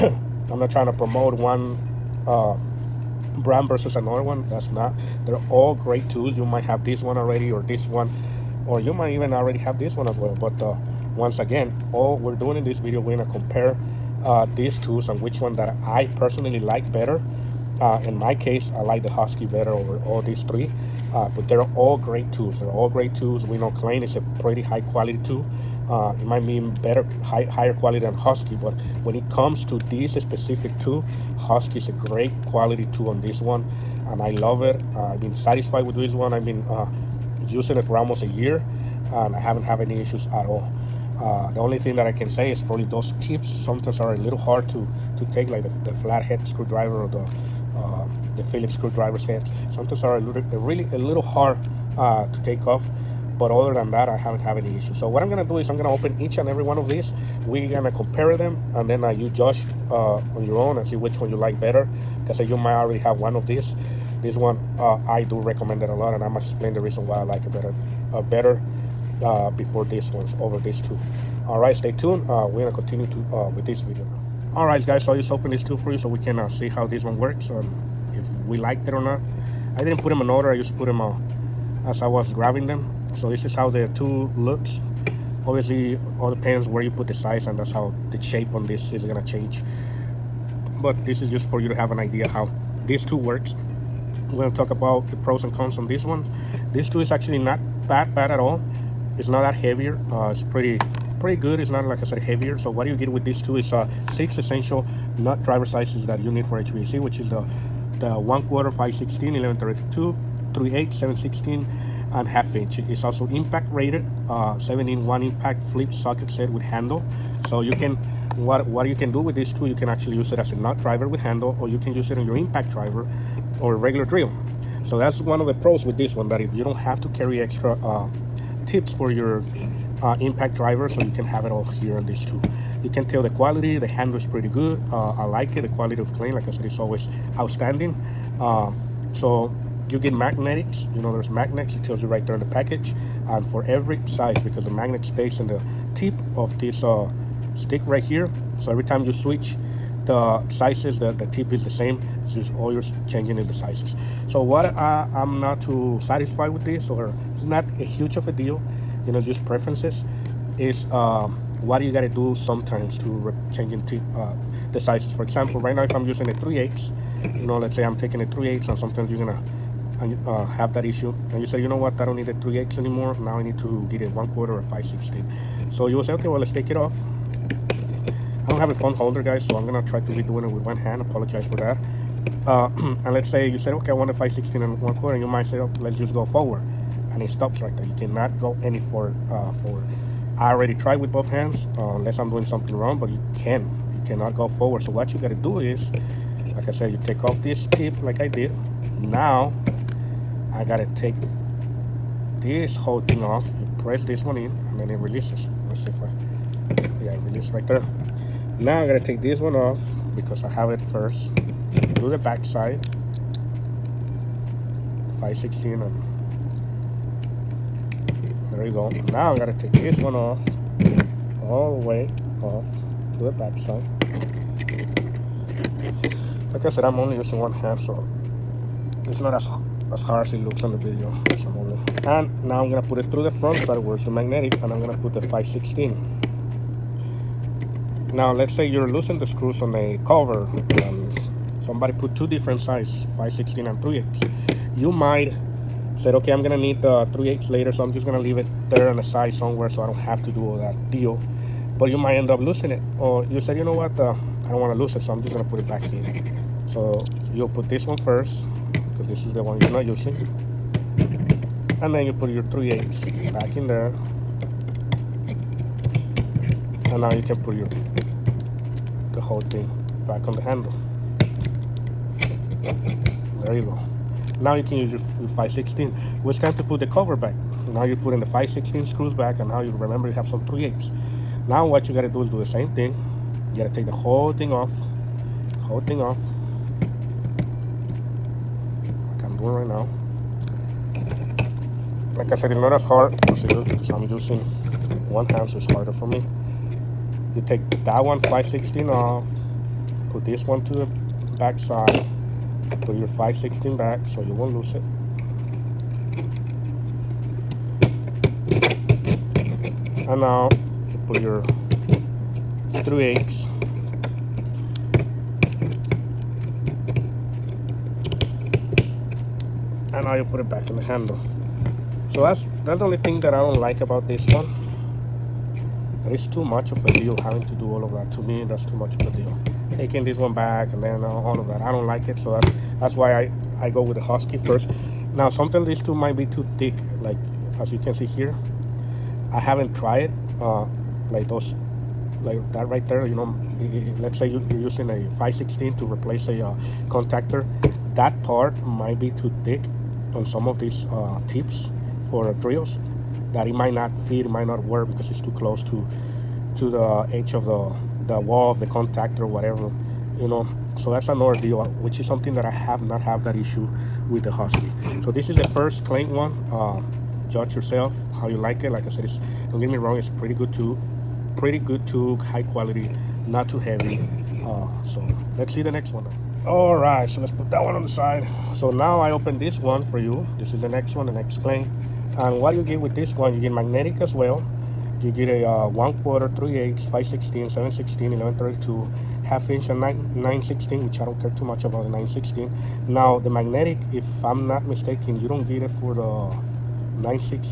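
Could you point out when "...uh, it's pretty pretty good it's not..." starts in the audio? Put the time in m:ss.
1:40.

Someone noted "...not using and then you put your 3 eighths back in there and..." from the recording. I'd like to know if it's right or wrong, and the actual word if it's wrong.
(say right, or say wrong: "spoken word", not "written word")
right.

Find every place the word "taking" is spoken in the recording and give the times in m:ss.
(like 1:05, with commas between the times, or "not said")
2:47, 5:29.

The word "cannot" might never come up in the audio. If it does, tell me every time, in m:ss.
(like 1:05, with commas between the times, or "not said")
3:07, 3:14.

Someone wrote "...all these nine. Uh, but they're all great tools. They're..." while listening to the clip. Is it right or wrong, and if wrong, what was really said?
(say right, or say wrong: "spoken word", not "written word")
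wrong: "three", not "nine".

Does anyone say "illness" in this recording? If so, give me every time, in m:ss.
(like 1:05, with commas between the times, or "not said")
not said.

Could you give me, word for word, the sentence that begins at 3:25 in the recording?
Let's see if I, yeah, release right there.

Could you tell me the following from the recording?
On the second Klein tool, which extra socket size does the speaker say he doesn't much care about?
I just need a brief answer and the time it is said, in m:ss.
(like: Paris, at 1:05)
9/16, at 6:31.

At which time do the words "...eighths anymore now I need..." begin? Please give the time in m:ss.
2:52.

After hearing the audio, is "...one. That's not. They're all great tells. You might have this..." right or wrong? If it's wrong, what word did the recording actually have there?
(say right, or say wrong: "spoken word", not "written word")
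wrong: "tools", not "tells".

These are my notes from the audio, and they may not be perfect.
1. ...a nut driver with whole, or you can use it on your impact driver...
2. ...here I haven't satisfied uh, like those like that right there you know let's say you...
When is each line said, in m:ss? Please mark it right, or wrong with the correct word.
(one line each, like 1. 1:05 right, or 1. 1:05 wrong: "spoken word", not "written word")
1. 2:00 wrong: "handle", not "whole"
2. 5:38 wrong: "tried", not "satisfied".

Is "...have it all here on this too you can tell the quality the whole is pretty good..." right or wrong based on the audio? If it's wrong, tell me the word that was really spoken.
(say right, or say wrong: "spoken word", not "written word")
wrong: "handle", not "whole".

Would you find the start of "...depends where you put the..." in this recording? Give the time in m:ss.
1:26.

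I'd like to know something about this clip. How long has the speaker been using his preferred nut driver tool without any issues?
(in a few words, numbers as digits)
almost a year.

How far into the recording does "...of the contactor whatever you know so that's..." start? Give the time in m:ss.
5:58.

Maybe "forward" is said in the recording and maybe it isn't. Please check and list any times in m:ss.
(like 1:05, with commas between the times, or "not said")
3:06, 3:14.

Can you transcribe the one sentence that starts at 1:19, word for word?
I didn't put them in order.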